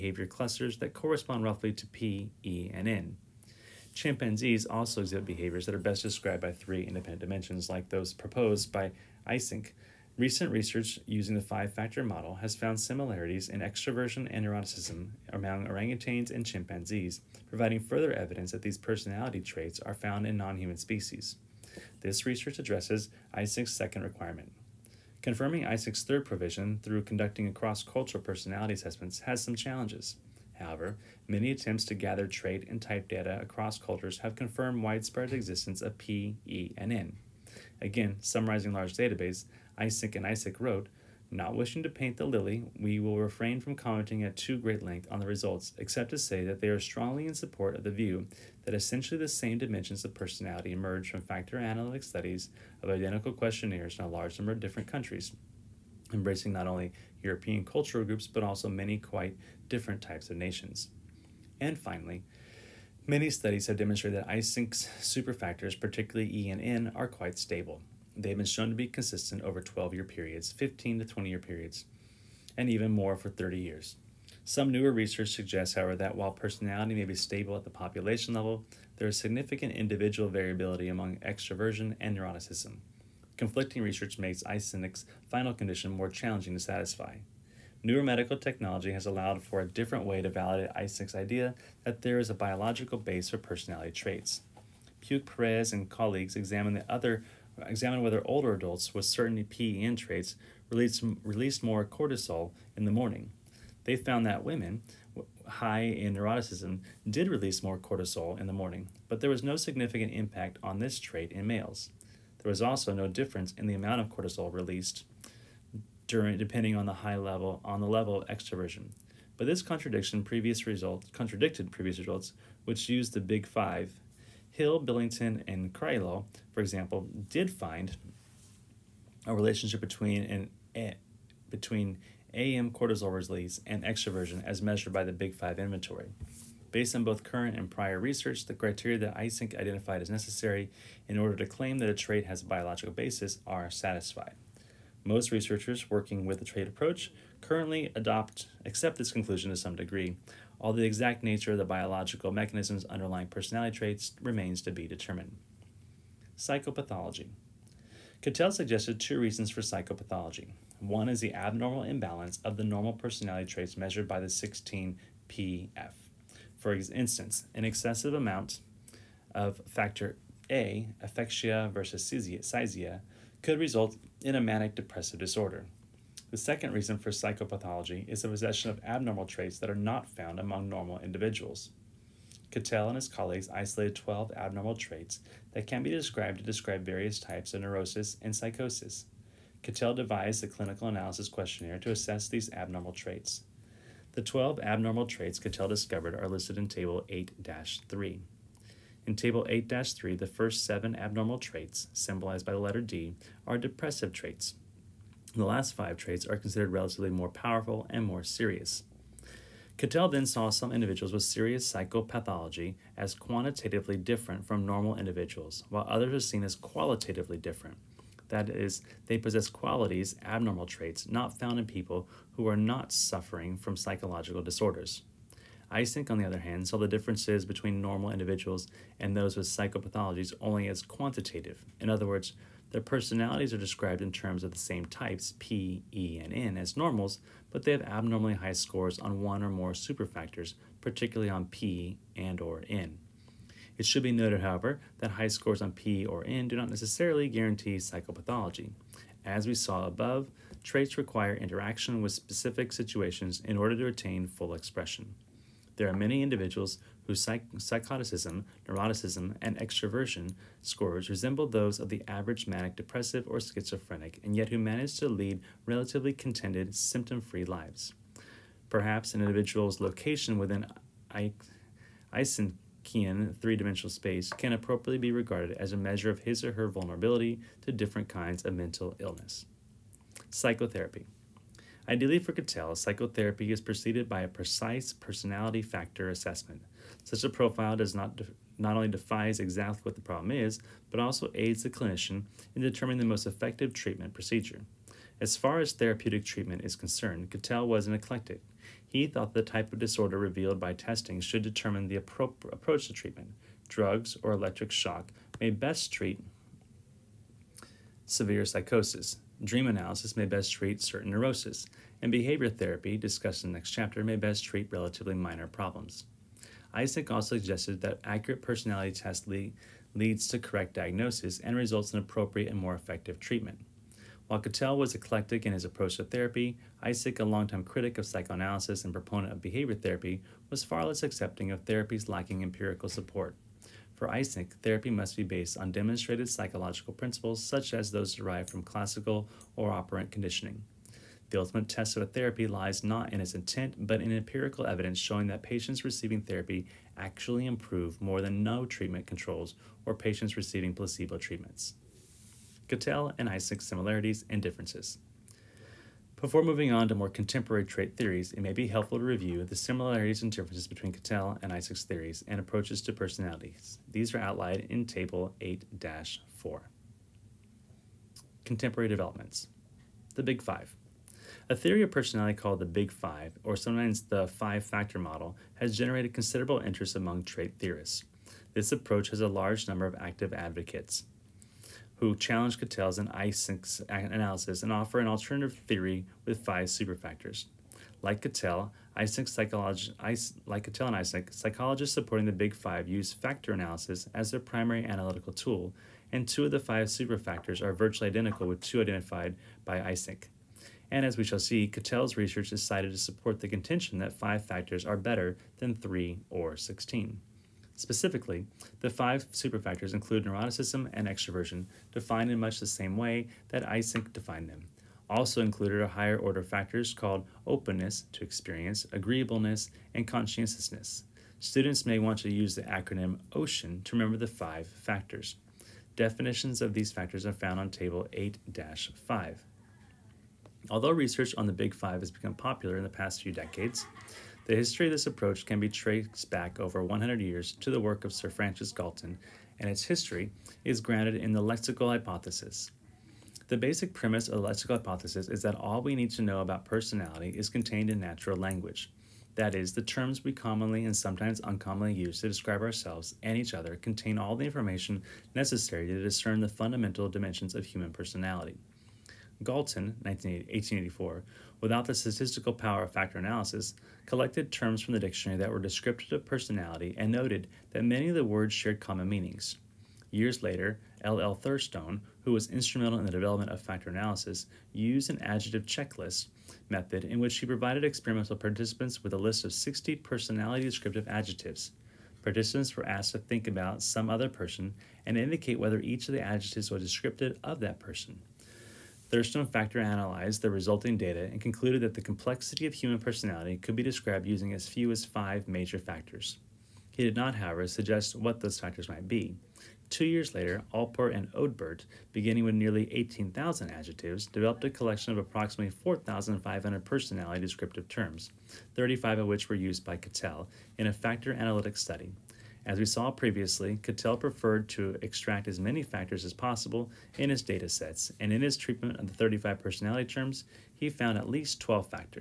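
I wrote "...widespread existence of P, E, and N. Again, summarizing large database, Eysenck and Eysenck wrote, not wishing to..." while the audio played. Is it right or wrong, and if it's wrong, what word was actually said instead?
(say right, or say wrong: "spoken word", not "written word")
right.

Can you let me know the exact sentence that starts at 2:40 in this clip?
One is the abnormal imbalance of the normal personality traits measured by the 16PF.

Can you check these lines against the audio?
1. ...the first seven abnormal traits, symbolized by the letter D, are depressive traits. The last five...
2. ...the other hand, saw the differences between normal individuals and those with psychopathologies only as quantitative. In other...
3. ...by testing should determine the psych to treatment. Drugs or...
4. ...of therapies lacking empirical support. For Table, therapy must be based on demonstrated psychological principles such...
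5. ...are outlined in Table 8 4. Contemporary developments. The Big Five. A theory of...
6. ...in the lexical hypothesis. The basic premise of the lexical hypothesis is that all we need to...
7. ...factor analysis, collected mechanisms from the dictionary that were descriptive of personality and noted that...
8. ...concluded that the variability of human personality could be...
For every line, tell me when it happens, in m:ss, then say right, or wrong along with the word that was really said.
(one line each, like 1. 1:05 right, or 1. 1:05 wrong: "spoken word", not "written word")
1. 3:20 right
2. 3:46 right
3. 5:00 wrong: "approach", not "psych"
4. 5:31 wrong: "Eysenck", not "Table"
5. 6:04 right
6. 7:21 right
7. 7:42 wrong: "terms", not "mechanisms"
8. 8:11 wrong: "complexity", not "variability".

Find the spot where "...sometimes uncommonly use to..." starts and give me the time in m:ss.
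7:30.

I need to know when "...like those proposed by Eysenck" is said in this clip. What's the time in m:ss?
0:07.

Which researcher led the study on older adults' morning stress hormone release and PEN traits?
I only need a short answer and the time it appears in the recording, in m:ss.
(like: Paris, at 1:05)
Puig-Perez, at 1:35.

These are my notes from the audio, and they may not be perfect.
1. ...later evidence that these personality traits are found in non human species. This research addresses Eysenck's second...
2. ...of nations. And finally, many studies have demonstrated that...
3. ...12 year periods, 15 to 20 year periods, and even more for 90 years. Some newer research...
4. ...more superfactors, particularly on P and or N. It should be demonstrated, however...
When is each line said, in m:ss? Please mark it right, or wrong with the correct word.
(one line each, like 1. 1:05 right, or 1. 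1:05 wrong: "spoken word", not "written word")
1. 0:17 wrong: "further", not "later"
2. 1:00 right
3. 1:09 wrong: "30", not "90"
4. 3:59 wrong: "noted", not "demonstrated".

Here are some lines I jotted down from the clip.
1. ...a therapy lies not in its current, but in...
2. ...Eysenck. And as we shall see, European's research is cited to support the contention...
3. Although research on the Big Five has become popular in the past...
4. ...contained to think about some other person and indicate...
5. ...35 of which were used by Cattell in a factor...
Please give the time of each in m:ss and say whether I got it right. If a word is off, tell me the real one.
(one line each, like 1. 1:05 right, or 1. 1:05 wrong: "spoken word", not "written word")
1. 5:42 wrong: "intent", not "current"
2. 6:39 wrong: "Cattell", not "European"
3. 7:10 right
4. 8:02 wrong: "asked", not "contained"
5. 8:28 right.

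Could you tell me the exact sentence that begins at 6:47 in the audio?
Specifically, the five superfactors include neuroticism and extroversion, defined in much the same way that Eysenck defined them.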